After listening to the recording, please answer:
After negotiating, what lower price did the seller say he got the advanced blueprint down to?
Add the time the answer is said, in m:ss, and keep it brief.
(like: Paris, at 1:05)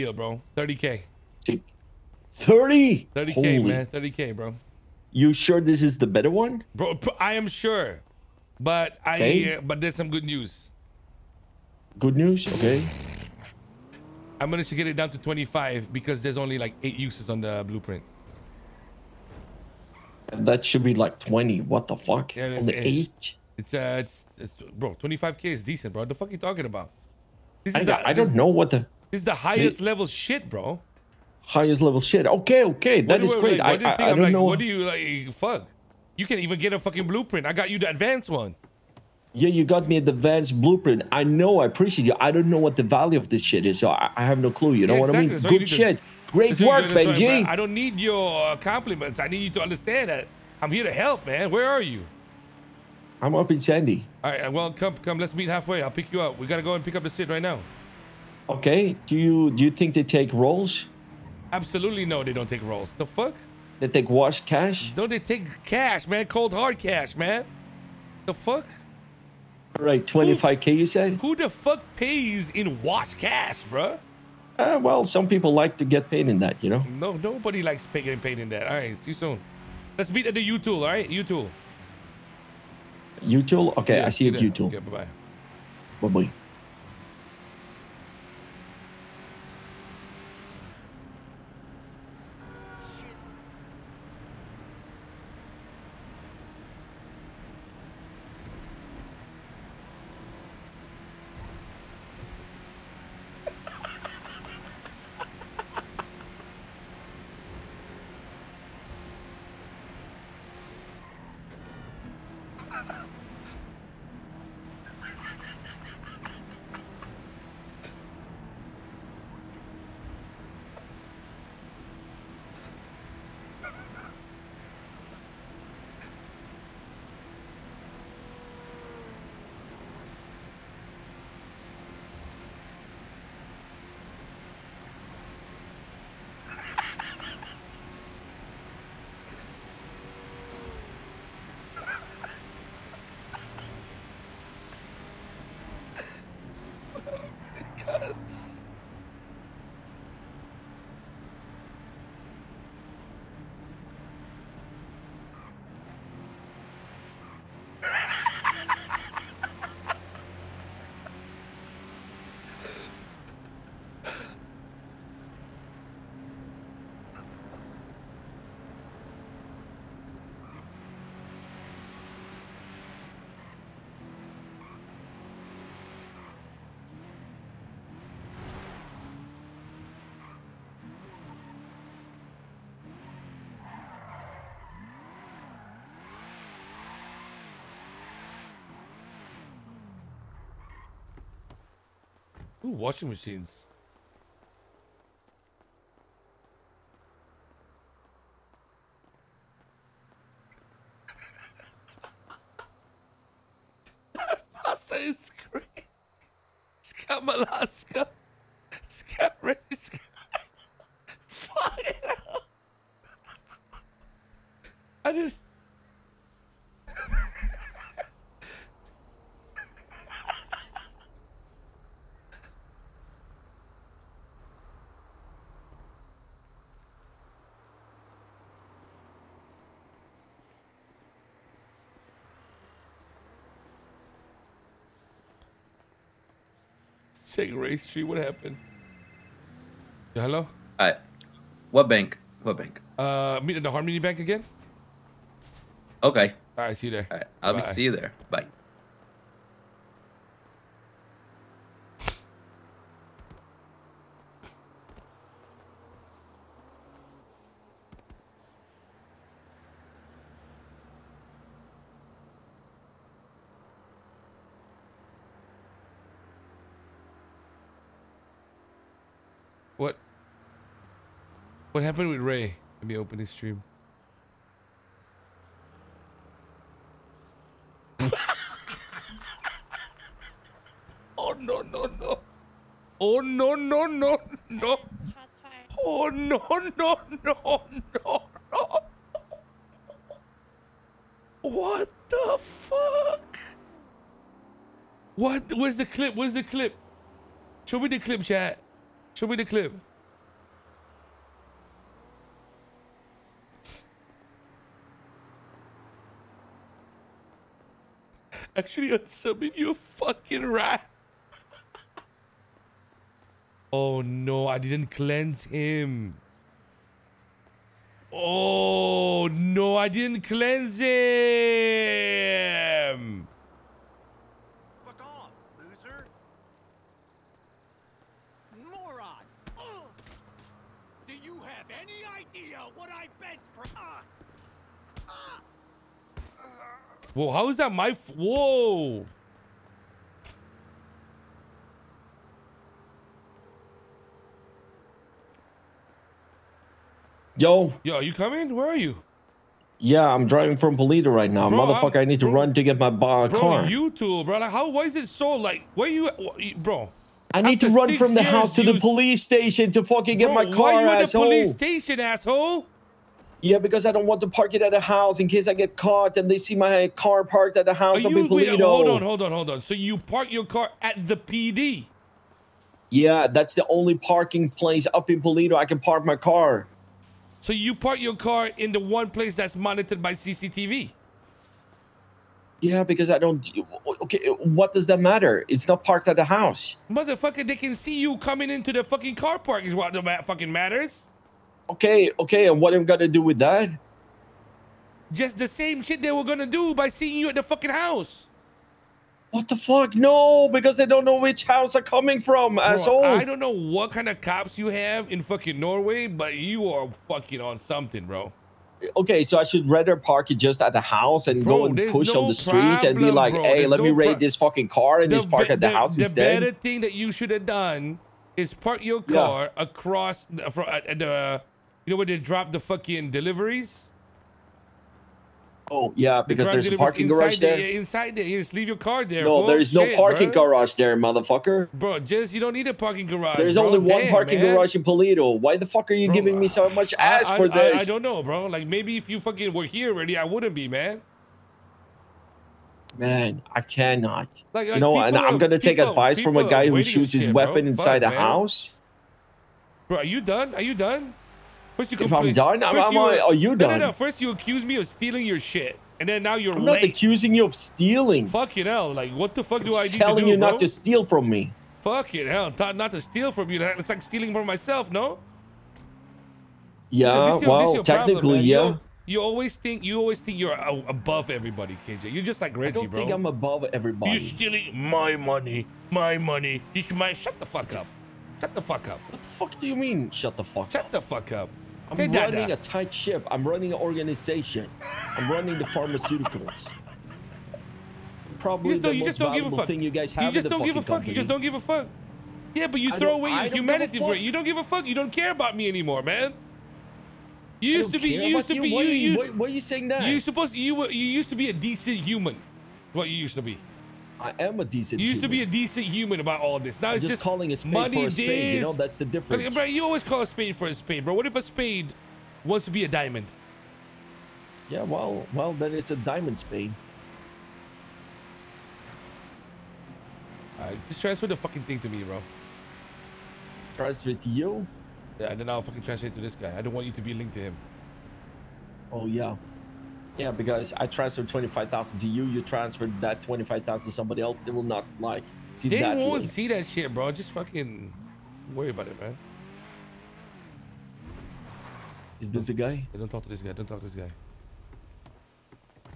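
25, at 0:14.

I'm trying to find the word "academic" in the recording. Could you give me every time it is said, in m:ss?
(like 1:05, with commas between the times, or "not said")
not said.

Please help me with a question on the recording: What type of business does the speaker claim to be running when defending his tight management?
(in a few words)
pharmaceuticals.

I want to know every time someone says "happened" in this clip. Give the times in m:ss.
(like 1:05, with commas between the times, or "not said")
3:58, 4:31.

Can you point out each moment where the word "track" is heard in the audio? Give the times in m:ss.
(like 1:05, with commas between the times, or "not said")
not said.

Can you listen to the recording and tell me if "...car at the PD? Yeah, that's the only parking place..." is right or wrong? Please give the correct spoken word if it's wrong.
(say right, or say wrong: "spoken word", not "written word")
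right.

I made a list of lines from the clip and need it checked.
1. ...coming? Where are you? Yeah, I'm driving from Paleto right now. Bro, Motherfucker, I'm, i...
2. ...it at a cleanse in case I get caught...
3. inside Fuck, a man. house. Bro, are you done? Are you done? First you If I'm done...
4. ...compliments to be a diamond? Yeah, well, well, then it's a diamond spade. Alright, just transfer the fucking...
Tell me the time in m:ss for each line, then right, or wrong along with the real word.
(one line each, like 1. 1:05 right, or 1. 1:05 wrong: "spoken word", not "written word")
1. 5:48 right
2. 6:04 wrong: "house", not "cleanse"
3. 7:27 right
4. 8:32 wrong: "wants", not "compliments".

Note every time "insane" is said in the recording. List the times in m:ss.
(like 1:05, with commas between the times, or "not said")
not said.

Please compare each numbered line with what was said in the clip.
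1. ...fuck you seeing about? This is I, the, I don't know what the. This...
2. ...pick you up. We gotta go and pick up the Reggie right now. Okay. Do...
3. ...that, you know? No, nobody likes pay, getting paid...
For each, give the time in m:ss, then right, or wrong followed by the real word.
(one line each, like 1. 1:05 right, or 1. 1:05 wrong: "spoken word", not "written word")
1. 0:26 wrong: "talking", not "seeing"
2. 0:55 wrong: "Sid", not "Reggie"
3. 1:16 right.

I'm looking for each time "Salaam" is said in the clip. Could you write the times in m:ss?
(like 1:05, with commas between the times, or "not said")
not said.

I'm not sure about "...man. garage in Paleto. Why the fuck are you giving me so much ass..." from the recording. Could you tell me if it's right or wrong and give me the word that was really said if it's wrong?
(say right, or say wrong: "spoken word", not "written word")
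right.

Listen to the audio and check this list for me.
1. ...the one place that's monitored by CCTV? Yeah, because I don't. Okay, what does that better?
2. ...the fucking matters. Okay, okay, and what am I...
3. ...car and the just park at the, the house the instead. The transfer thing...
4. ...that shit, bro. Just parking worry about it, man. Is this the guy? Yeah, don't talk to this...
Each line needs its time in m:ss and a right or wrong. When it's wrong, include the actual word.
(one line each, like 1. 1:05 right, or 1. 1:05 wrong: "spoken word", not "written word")
1. 6:18 wrong: "matter", not "better"
2. 6:29 right
3. 6:54 wrong: "better", not "transfer"
4. 8:56 wrong: "fucking", not "parking".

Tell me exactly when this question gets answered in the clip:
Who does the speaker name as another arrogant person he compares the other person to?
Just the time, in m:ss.
7:52.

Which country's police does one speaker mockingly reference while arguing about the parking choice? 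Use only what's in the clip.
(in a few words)
Norway.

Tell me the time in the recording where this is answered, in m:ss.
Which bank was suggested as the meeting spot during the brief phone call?
4:03.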